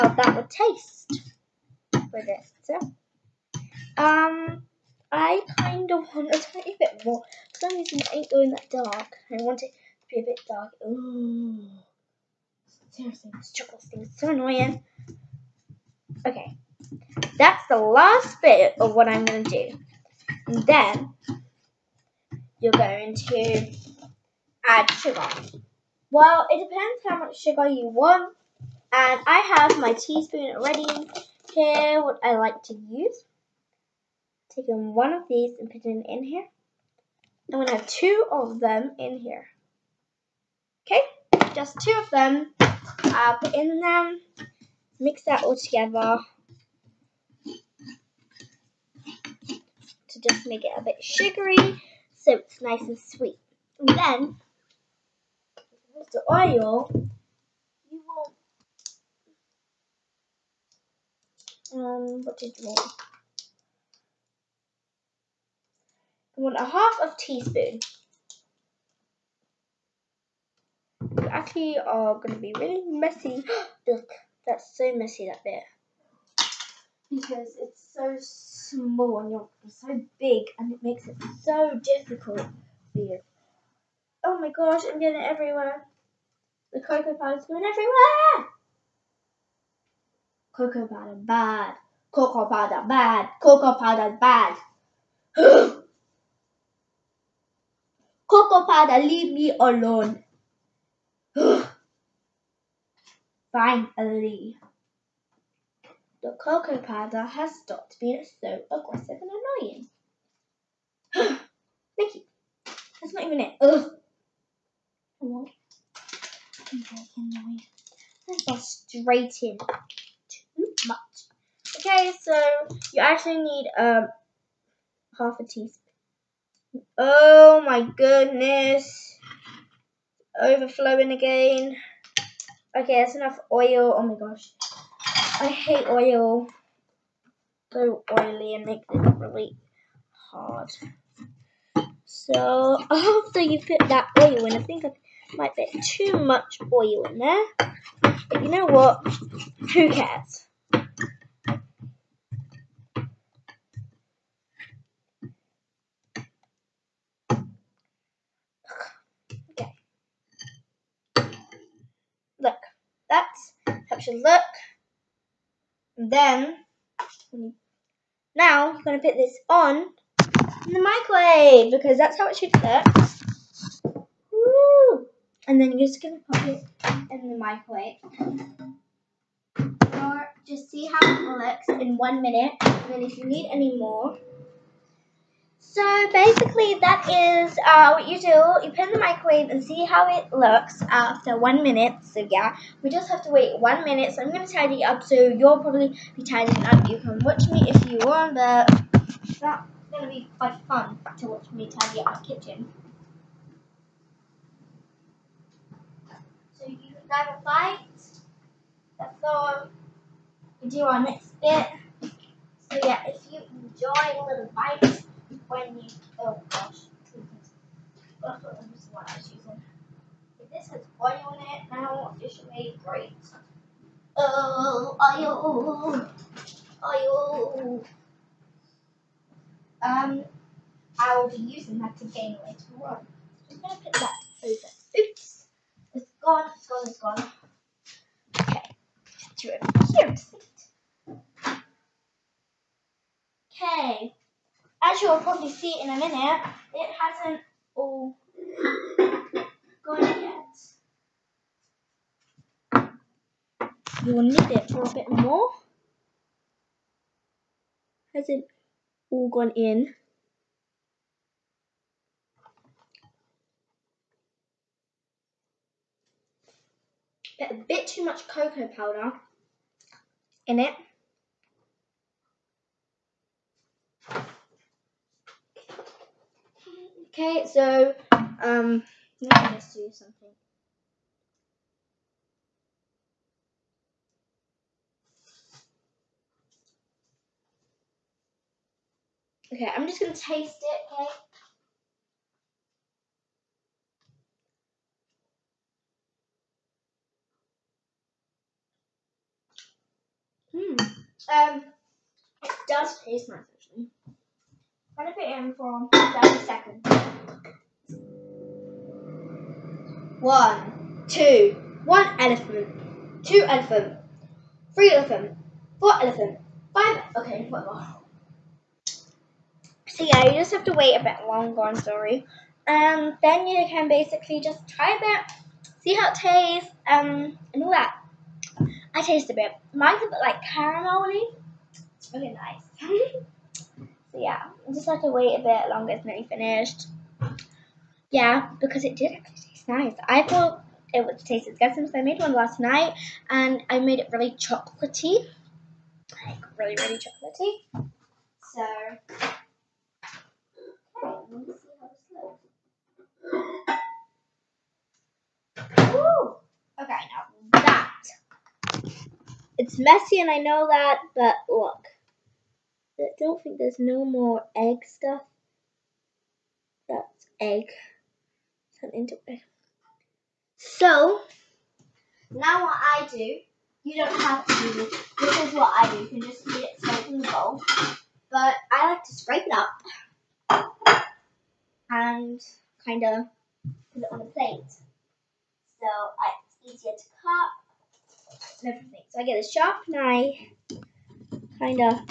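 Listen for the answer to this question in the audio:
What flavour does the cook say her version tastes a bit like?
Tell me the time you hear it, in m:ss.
5:30.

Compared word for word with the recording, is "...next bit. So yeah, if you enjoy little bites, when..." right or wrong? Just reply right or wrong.
right.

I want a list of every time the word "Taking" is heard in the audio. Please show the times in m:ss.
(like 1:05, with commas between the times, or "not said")
0:34.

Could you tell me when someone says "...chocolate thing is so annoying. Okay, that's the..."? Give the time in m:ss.
0:13.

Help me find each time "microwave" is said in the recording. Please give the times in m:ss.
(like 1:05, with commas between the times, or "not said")
2:50, 2:57, 3:08.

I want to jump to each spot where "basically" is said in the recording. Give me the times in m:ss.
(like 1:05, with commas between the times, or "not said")
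3:06, 5:23.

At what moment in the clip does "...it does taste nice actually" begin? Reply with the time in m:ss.
5:02.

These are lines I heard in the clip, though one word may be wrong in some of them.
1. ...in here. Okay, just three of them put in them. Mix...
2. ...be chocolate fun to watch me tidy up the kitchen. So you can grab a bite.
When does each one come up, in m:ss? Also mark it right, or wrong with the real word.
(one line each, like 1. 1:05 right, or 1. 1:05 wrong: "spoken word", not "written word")
1. 0:38 wrong: "two", not "three"
2. 3:20 wrong: "quite", not "chocolate".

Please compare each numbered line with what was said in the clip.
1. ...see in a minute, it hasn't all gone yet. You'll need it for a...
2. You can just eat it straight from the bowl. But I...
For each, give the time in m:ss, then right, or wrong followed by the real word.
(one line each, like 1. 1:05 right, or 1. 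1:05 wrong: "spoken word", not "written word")
1. 4:05 right
2. 6:16 right.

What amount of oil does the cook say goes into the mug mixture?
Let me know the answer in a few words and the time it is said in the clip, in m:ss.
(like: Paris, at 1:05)
half a teaspoon, at 2:05.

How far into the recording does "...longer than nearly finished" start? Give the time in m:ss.
5:35.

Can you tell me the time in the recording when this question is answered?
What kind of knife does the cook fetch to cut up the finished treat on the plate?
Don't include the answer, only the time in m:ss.
6:29.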